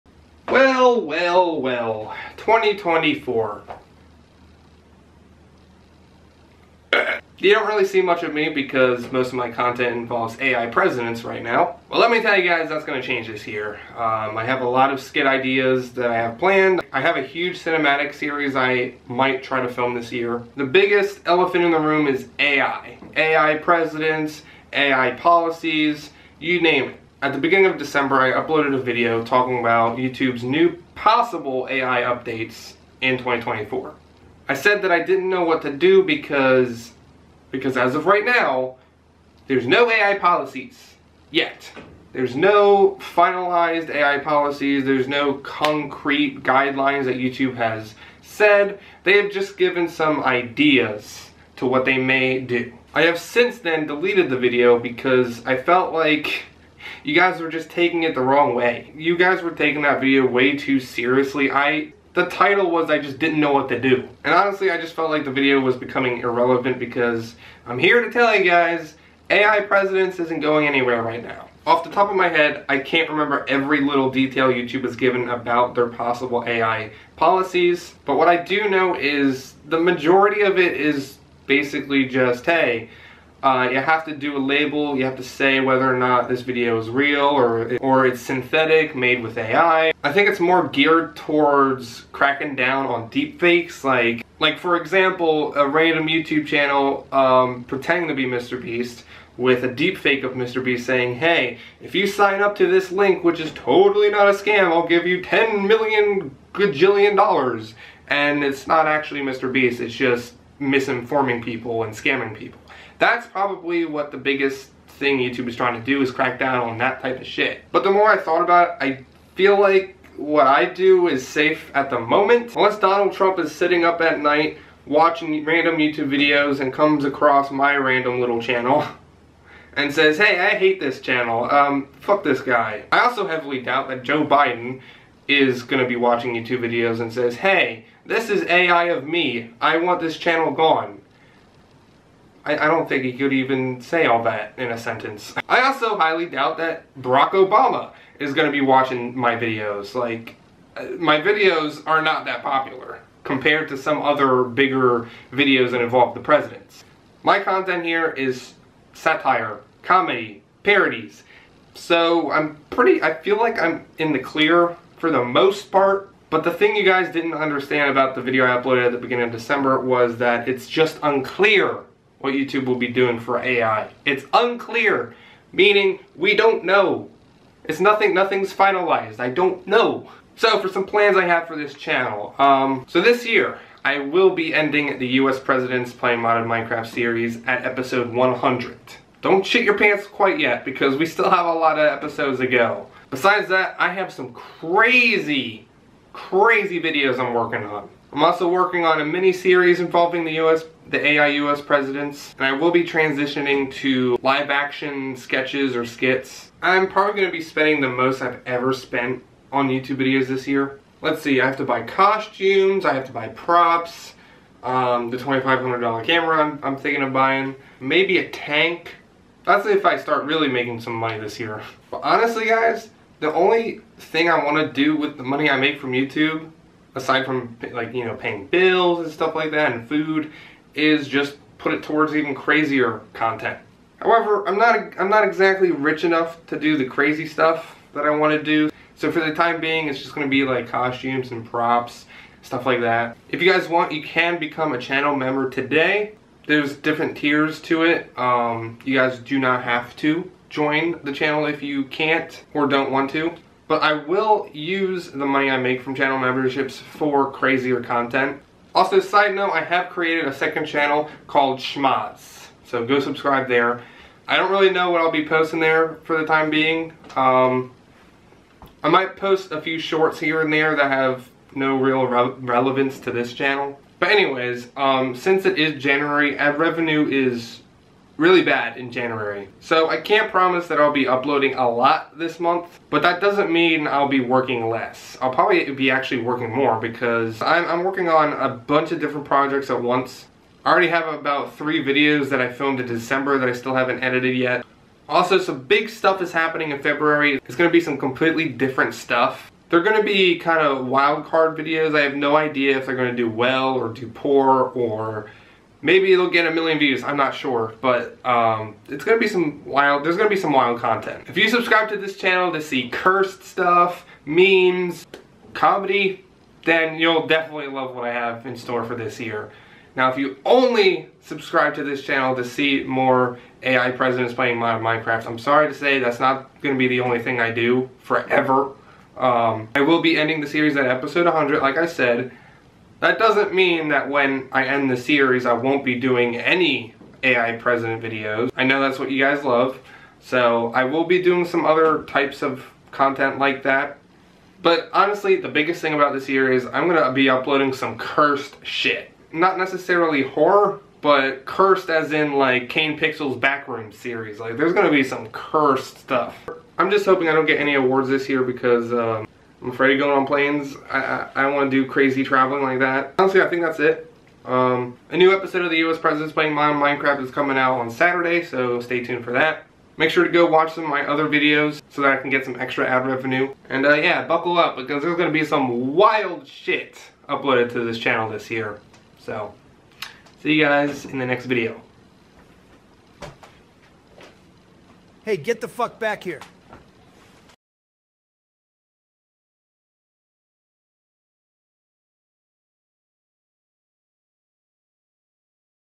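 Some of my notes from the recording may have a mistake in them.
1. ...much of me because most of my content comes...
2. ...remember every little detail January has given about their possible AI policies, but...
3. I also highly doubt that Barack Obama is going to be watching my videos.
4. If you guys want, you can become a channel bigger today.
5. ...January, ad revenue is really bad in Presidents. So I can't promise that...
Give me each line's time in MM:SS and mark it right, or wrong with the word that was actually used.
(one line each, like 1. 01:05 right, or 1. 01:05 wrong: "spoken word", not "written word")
1. 00:08 wrong: "involves", not "comes"
2. 01:13 wrong: "YouTube", not "January"
3. 02:25 right
4. 04:03 wrong: "member", not "bigger"
5. 04:35 wrong: "January", not "Presidents".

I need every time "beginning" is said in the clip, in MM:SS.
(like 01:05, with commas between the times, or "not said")
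00:27, 02:48.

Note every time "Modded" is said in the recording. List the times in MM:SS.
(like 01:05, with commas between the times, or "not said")
03:06, 06:06.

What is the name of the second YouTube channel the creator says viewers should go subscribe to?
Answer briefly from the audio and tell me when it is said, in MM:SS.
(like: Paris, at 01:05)
Schmatz, at 04:21.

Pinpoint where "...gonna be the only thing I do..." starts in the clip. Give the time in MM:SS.
05:26.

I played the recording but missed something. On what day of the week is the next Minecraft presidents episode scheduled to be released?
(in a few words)
Saturday.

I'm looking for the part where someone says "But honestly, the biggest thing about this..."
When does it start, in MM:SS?
05:44.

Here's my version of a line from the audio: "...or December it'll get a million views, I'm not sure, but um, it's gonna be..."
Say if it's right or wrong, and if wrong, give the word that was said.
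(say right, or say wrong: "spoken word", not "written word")
wrong: "Maybe", not "December".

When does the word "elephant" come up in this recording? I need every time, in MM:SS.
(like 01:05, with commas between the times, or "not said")
00:21.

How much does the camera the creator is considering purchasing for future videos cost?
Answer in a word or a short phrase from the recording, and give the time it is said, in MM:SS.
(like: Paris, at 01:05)
$2,500, at 03:35.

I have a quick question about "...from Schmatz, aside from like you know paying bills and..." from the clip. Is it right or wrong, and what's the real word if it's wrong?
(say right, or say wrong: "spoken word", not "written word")
wrong: "YouTube", not "Schmatz".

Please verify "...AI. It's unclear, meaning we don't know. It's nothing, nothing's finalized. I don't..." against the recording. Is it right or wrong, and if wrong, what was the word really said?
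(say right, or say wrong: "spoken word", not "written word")
right.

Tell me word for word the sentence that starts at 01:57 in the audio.
But the more I thought about it, I feel like what I do is safe at the moment.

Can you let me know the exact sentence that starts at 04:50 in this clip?
I already have about three videos that I filmed in December that I still haven't edited yet.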